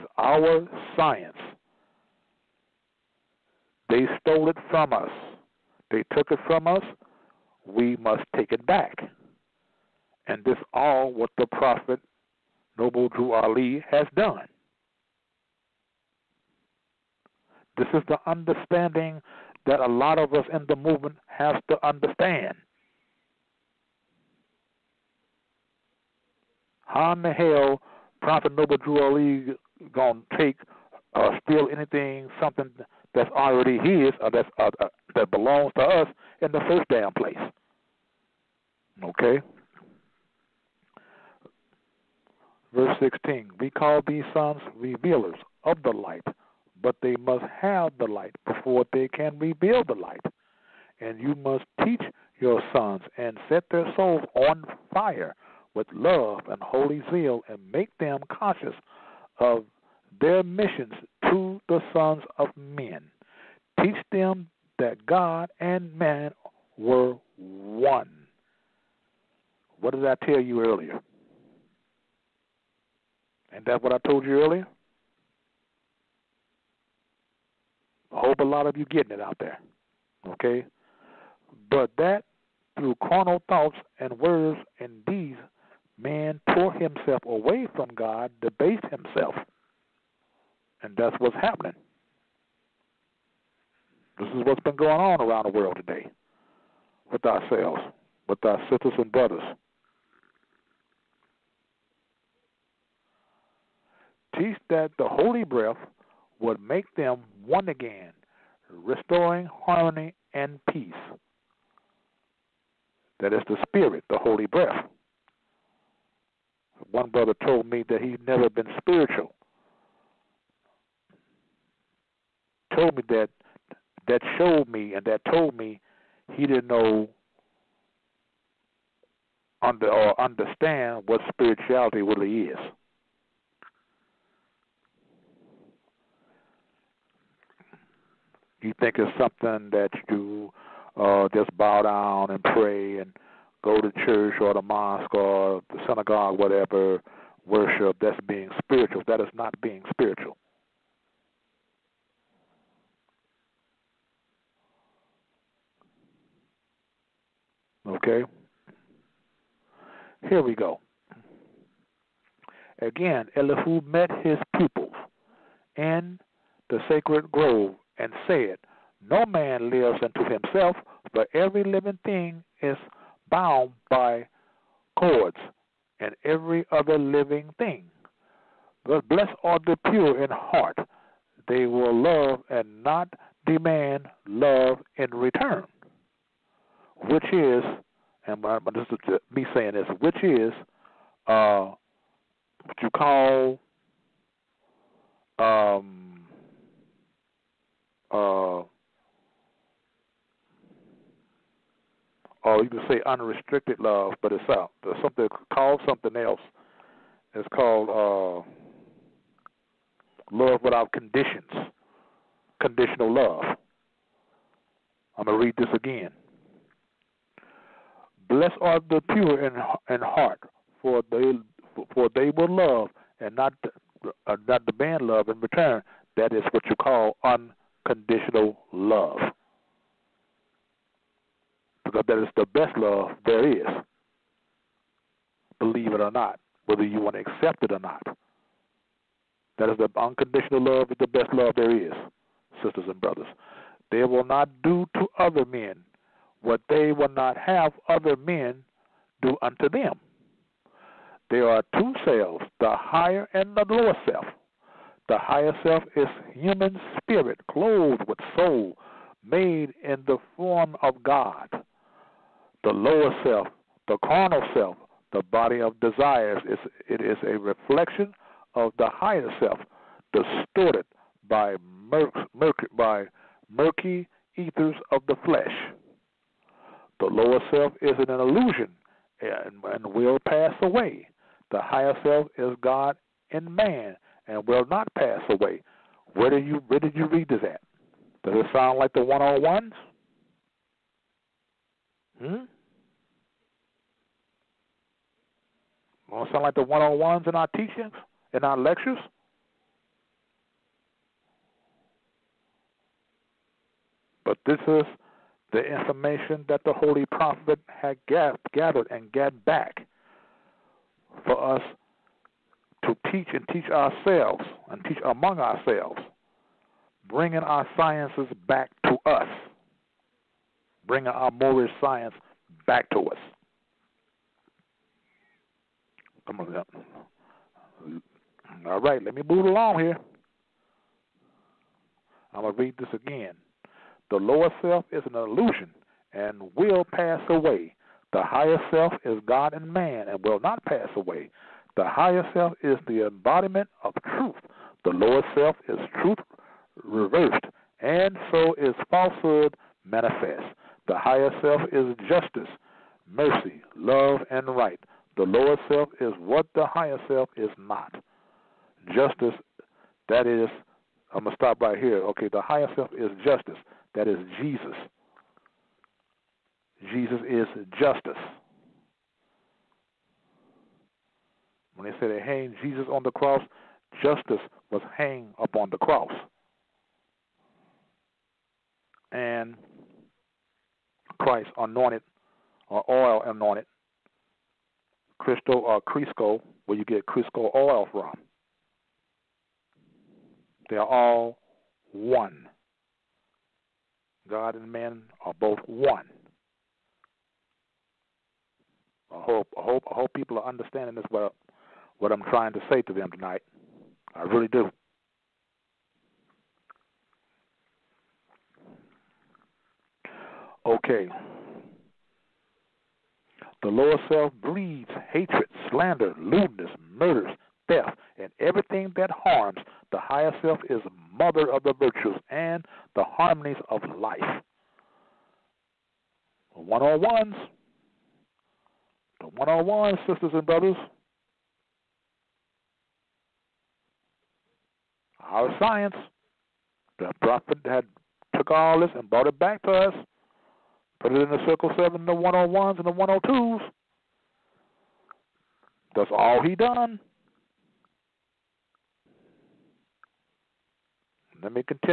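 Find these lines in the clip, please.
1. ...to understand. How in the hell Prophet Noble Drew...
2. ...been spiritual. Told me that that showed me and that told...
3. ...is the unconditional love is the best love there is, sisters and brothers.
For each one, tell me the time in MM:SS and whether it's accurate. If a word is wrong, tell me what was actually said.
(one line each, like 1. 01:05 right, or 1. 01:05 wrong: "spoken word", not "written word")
1. 00:21 right
2. 01:58 right
3. 03:59 right.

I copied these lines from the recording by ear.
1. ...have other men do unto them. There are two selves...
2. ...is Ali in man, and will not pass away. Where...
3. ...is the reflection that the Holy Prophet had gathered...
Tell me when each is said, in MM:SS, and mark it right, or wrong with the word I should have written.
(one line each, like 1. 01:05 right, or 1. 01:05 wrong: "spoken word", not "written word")
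1. 04:07 right
2. 04:42 wrong: "God", not "Ali"
3. 05:04 wrong: "information", not "reflection".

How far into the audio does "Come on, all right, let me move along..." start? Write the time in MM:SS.
05:26.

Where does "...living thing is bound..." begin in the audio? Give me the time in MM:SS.
02:51.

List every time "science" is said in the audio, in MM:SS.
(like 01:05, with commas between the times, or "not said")
00:00, 05:17, 05:21, 07:15.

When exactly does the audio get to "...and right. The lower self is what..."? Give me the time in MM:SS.
05:54.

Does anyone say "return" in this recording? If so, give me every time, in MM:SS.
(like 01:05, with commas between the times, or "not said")
03:05, 03:45.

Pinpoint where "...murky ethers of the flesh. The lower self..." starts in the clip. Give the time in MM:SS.
04:33.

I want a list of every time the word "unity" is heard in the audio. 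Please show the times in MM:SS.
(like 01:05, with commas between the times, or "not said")
not said.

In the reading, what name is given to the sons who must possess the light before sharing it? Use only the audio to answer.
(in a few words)
Revealers of the light.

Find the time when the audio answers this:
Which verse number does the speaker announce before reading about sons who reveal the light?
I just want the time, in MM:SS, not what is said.
00:42.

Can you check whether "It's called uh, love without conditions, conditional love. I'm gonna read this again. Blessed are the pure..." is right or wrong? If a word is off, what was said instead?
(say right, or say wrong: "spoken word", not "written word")
right.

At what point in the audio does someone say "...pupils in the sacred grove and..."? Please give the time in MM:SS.
02:44.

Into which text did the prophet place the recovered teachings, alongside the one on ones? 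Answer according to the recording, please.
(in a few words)
Circle Seven.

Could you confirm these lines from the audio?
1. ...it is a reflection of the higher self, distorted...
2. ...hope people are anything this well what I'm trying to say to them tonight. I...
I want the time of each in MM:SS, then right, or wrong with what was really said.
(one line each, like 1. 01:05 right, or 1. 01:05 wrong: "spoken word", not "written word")
1. 04:26 right
2. 06:39 wrong: "understanding", not "anything".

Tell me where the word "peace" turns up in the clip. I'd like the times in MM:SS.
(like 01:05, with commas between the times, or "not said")
01:50.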